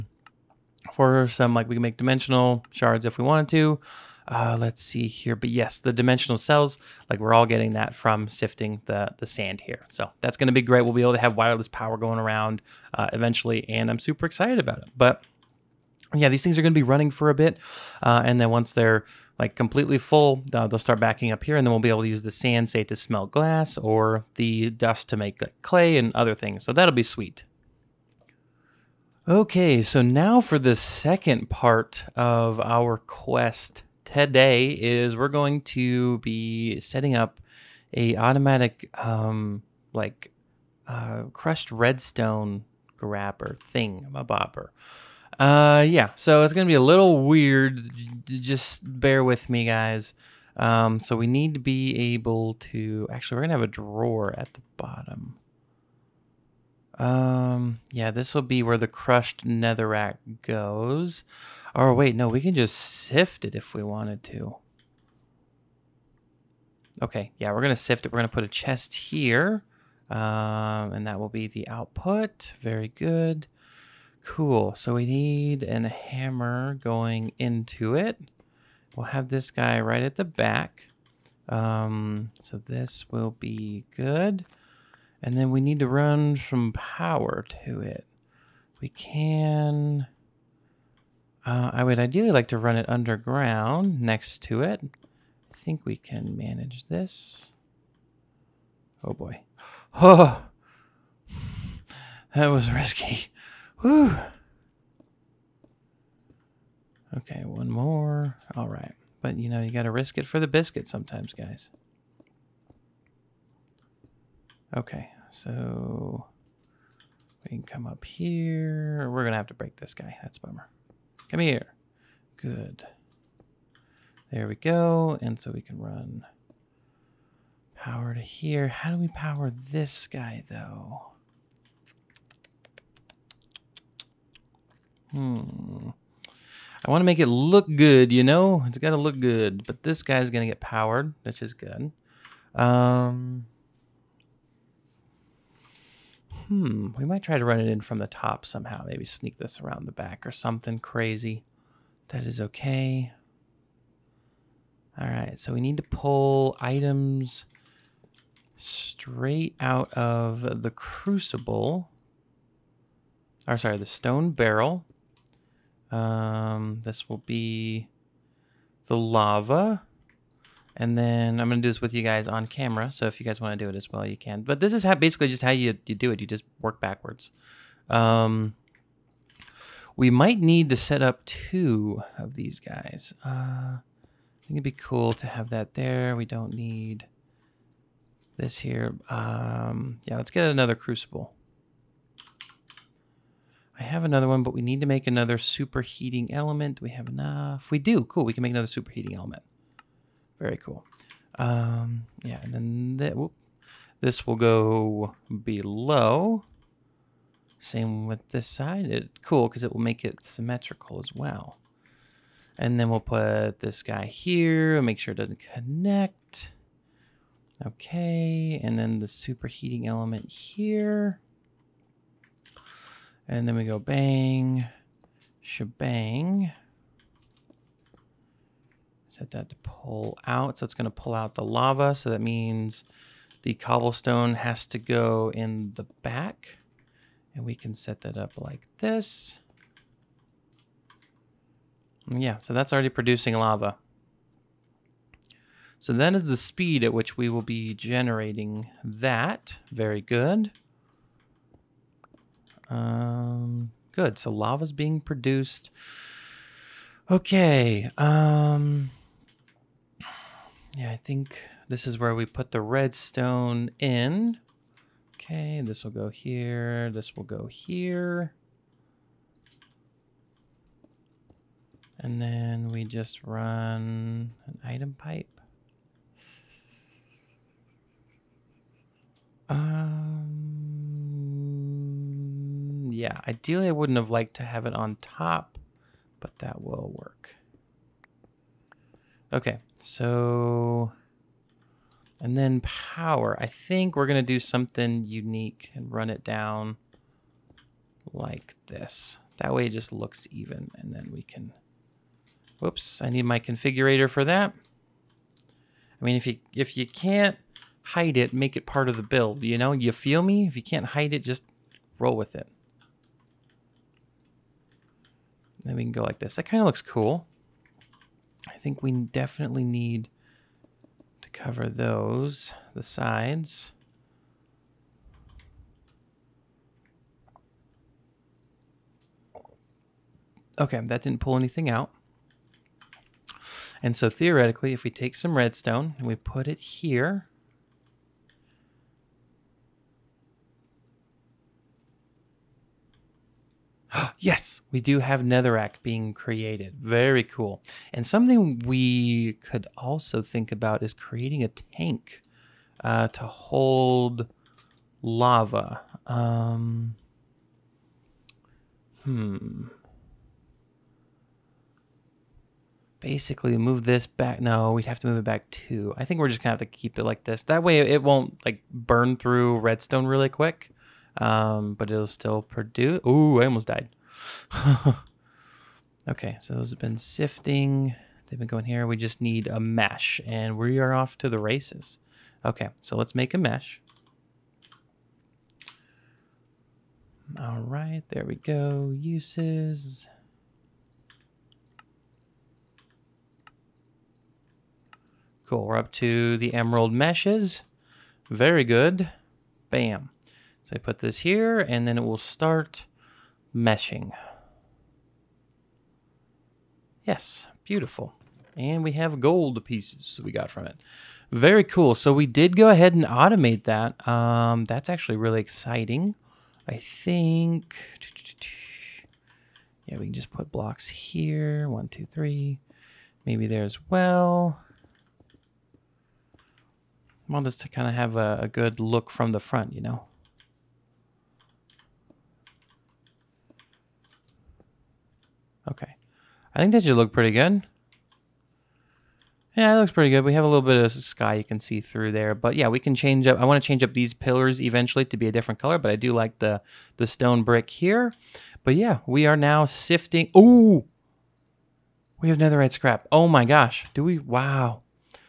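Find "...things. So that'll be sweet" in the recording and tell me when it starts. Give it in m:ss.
0:26.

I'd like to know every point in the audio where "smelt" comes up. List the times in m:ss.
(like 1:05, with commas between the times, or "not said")
0:22.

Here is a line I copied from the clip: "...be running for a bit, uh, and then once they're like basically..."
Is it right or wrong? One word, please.
wrong.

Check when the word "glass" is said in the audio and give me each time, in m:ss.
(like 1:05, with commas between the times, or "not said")
0:23.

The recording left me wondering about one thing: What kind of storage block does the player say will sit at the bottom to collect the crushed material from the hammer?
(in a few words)
A drawer.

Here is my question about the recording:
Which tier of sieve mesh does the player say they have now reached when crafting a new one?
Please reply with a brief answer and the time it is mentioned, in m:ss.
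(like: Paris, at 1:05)
Emerald meshes, at 6:36.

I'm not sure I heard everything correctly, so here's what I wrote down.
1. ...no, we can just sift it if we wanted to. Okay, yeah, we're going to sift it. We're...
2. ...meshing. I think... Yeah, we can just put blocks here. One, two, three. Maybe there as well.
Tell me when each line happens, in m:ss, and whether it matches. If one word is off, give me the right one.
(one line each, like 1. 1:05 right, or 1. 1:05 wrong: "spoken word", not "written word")
1. 1:02 right
2. 6:55 wrong: "exciting", not "meshing".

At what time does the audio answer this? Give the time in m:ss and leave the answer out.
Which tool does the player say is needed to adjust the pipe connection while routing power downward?
5:03.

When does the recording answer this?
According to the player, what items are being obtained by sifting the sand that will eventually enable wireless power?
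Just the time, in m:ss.
0:05.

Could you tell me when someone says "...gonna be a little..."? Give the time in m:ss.
0:46.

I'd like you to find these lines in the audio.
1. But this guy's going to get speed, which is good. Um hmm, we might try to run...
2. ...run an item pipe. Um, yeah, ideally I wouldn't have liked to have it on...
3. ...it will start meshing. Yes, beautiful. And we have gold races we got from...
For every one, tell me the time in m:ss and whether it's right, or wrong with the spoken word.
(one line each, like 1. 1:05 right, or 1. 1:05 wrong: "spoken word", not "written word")
1. 2:19 wrong: "powered", not "speed"
2. 4:33 right
3. 6:41 wrong: "pieces", not "races".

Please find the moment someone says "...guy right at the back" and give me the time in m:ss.
1:19.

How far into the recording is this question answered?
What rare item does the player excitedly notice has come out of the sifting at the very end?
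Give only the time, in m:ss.
7:32.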